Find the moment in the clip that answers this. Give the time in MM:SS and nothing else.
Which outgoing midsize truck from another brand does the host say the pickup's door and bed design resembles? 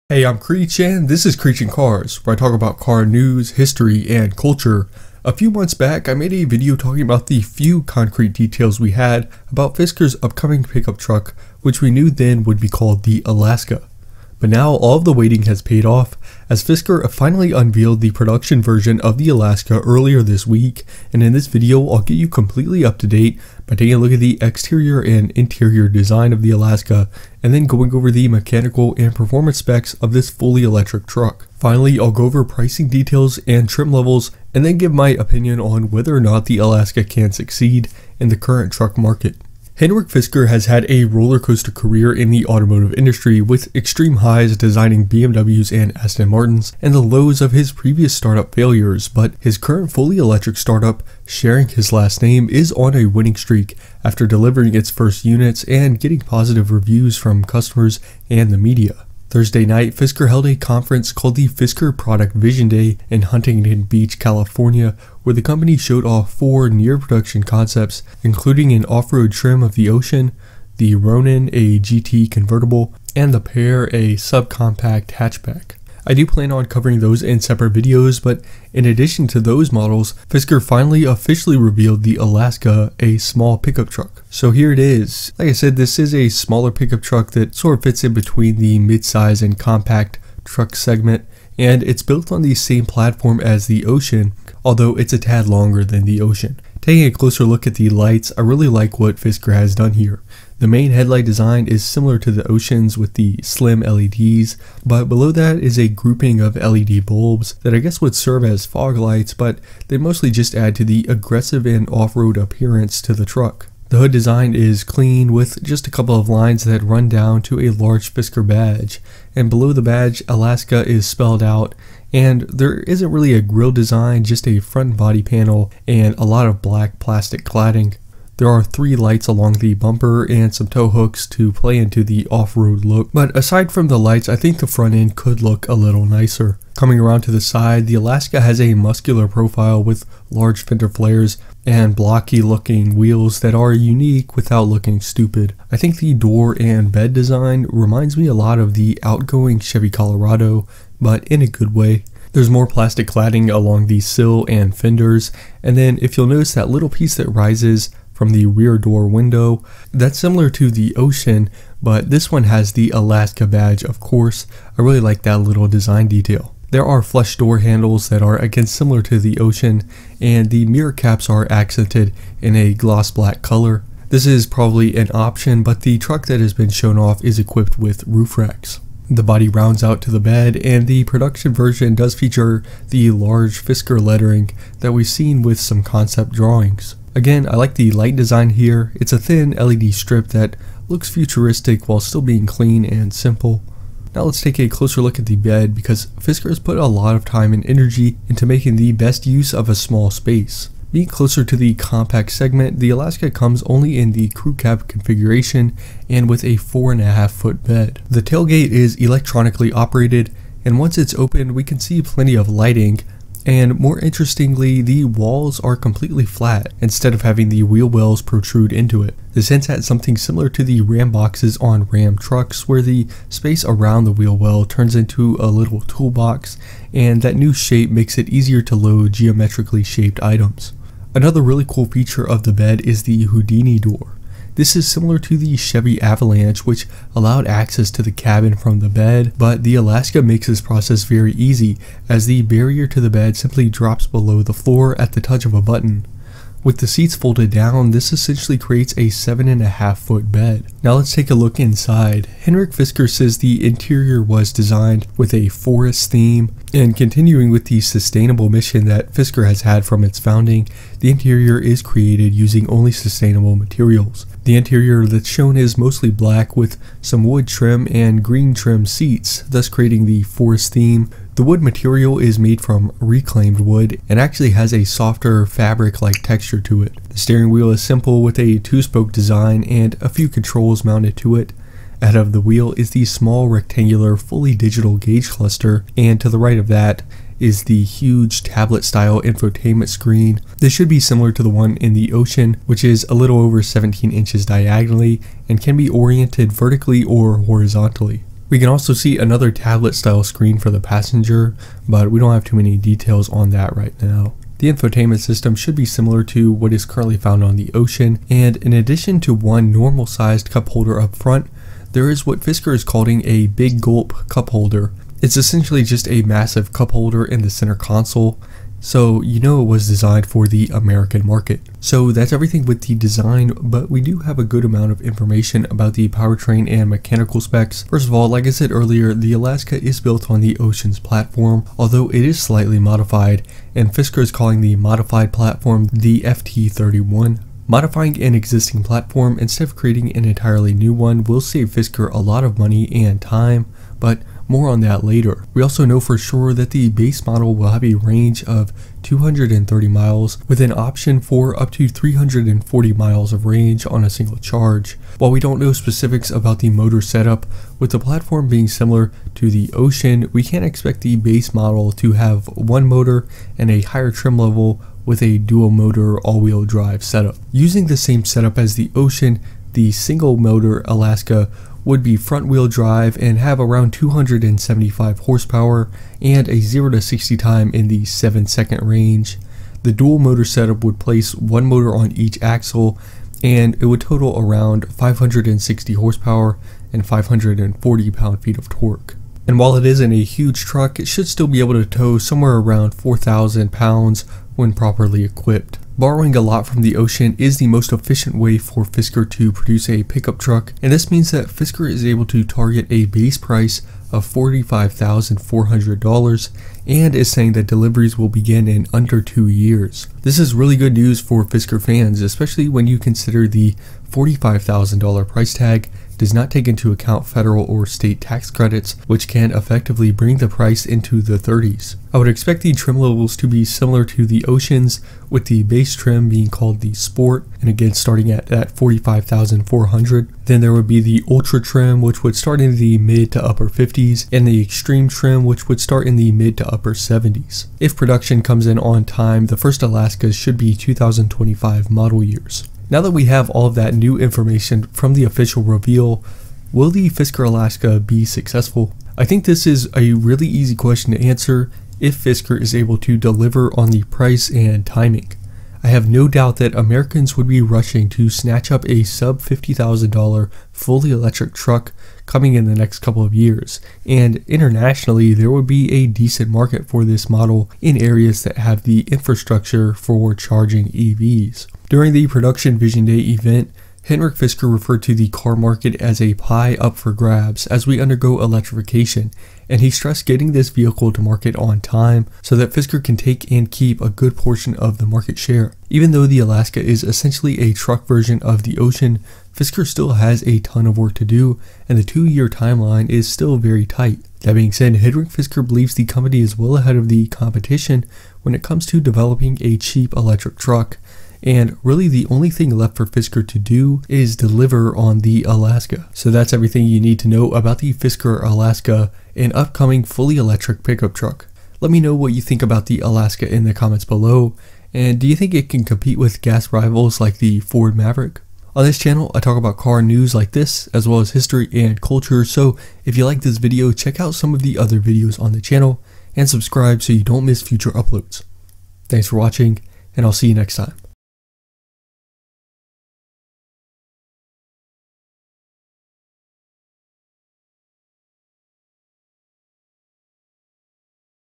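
02:29.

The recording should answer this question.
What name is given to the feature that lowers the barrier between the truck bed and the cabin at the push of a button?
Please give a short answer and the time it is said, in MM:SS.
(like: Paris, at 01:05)
Houdini door, at 03:53.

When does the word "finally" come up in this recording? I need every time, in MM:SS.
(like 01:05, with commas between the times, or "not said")
00:17, 00:31, 01:20.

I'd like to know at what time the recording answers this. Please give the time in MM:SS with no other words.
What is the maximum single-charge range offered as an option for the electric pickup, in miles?
05:51.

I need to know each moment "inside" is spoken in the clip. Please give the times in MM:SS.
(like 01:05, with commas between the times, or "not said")
04:11.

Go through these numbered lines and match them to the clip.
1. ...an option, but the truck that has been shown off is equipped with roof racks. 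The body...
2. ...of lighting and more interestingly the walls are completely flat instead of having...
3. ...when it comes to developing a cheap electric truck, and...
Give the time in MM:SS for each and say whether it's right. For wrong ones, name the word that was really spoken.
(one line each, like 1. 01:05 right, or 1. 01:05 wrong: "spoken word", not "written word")
1. 02:54 right
2. 03:32 right
3. 08:18 right.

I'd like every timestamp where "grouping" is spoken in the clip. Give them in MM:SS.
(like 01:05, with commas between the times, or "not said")
01:45.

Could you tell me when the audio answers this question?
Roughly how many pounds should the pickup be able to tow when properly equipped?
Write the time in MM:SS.
06:32.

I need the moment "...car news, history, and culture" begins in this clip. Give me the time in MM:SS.
00:02.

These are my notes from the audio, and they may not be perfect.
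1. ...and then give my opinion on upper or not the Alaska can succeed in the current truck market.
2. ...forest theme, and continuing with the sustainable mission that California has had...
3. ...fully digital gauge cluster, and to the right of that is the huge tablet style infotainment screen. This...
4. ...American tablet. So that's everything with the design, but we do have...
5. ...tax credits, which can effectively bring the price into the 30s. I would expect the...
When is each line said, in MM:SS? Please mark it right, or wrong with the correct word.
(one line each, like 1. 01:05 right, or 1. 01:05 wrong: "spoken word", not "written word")
1. 00:34 wrong: "whether", not "upper"
2. 04:15 wrong: "Fisker", not "California"
3. 04:44 right
4. 05:20 wrong: "market", not "tablet"
5. 06:58 right.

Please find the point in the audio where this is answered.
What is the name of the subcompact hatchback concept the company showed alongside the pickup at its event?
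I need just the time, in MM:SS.
01:13.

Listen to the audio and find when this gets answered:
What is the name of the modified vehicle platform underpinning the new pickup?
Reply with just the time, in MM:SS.
05:36.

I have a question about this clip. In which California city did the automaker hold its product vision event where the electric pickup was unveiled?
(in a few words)
Huntington Beach.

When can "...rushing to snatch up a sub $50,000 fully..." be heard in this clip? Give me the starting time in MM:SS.
07:37.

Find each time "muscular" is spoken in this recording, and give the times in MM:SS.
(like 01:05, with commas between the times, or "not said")
02:18.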